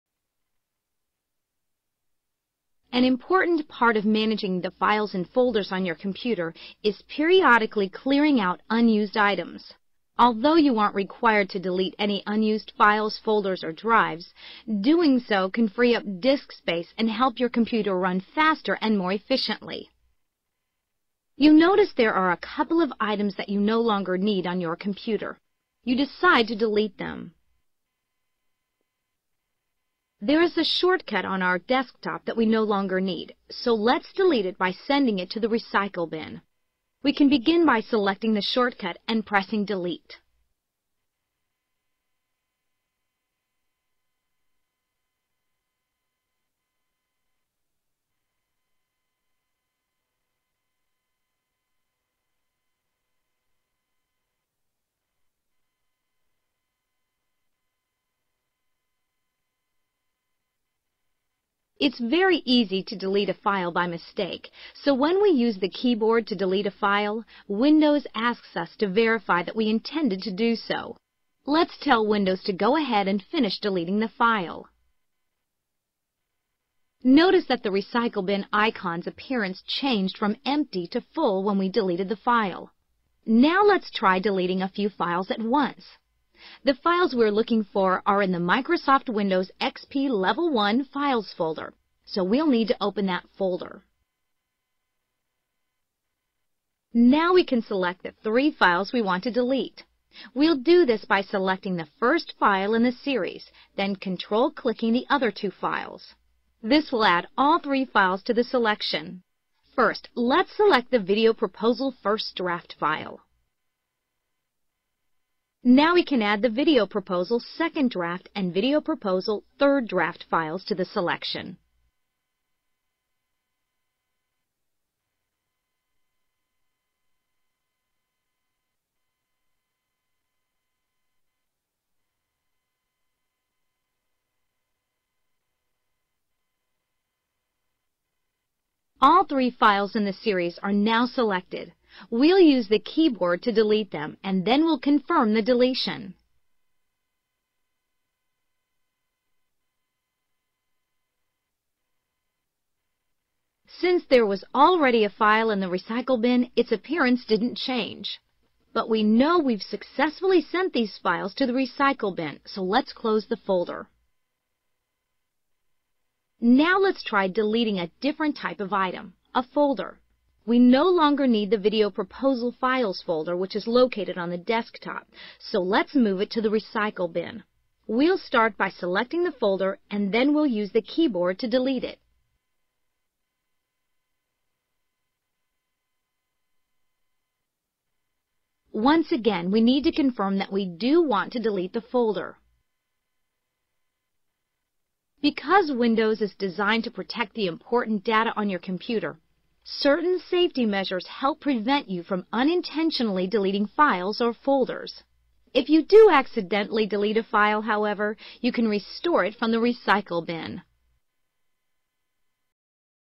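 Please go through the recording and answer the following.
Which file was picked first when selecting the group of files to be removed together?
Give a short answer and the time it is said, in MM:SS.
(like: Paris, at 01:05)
Video Proposal First Draft, at 01:50.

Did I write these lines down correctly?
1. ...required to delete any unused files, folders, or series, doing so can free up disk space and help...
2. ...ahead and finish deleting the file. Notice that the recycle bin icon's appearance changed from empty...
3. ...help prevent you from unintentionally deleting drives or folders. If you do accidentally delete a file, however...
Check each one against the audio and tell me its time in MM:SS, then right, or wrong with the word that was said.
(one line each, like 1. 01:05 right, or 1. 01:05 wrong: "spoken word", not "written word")
1. 00:10 wrong: "drives", not "series"
2. 01:12 right
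3. 03:21 wrong: "files", not "drives".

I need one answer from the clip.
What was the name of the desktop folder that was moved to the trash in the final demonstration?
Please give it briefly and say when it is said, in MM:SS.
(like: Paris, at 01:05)
video proposal files, at 02:51.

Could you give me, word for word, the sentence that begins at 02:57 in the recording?
We'll start by selecting the folder and then we'll use the keyboard to delete it.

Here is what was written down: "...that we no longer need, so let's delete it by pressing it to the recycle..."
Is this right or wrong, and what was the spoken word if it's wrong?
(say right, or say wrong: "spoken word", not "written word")
wrong: "sending", not "pressing".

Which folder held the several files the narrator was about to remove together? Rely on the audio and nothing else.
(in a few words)
Microsoft Windows XP Level 1 Files.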